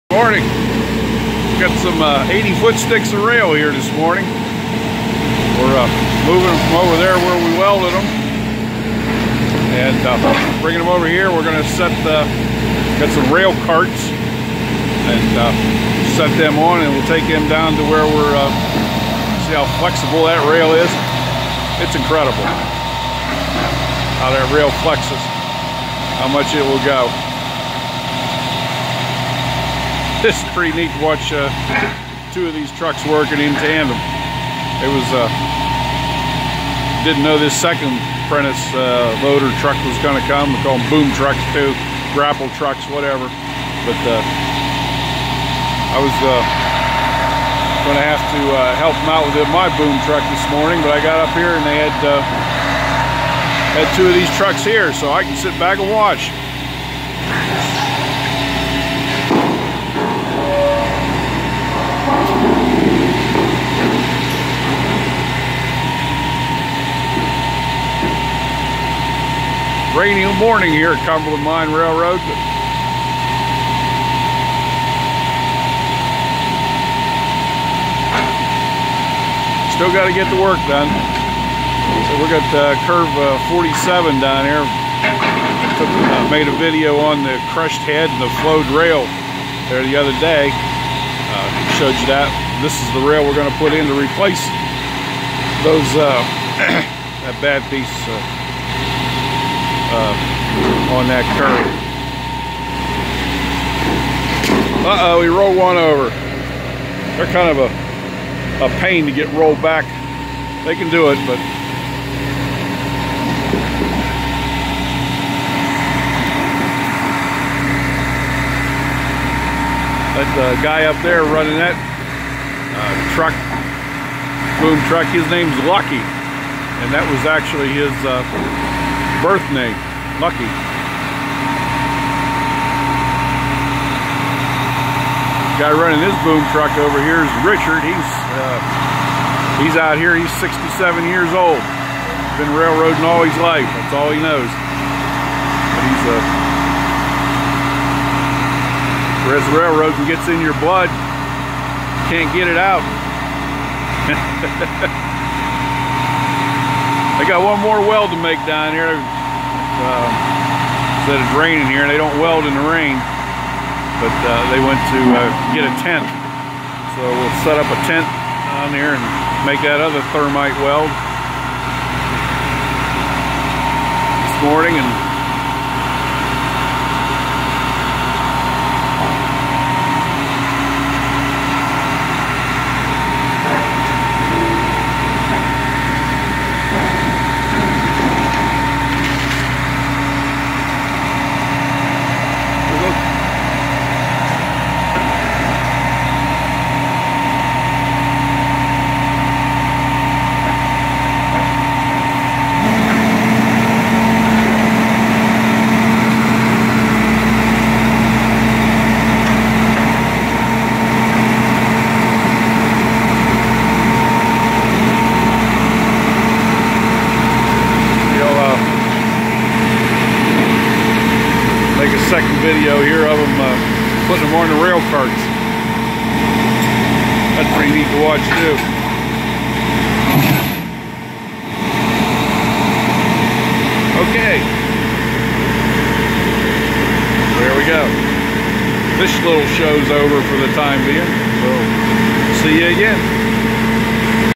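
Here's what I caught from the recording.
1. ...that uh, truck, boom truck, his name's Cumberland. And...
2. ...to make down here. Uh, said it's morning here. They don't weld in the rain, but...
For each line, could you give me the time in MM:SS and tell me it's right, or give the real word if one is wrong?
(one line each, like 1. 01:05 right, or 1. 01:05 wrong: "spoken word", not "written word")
1. 02:01 wrong: "Lucky", not "Cumberland"
2. 02:38 wrong: "raining", not "morning".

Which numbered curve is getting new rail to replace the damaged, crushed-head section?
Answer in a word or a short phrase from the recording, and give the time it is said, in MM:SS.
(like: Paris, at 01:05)
Curve 47, at 01:23.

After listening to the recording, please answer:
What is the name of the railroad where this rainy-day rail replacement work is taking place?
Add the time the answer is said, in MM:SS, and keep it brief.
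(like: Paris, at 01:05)
Cumberland Mine Railroad, at 01:11.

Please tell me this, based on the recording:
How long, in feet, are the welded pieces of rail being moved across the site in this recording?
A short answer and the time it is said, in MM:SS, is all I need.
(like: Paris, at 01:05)
80 feet, at 00:02.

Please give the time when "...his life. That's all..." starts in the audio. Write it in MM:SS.
02:23.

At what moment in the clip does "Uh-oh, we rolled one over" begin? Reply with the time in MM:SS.
01:44.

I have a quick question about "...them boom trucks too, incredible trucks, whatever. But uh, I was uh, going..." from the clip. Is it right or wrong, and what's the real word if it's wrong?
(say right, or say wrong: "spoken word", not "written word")
wrong: "grapple", not "incredible".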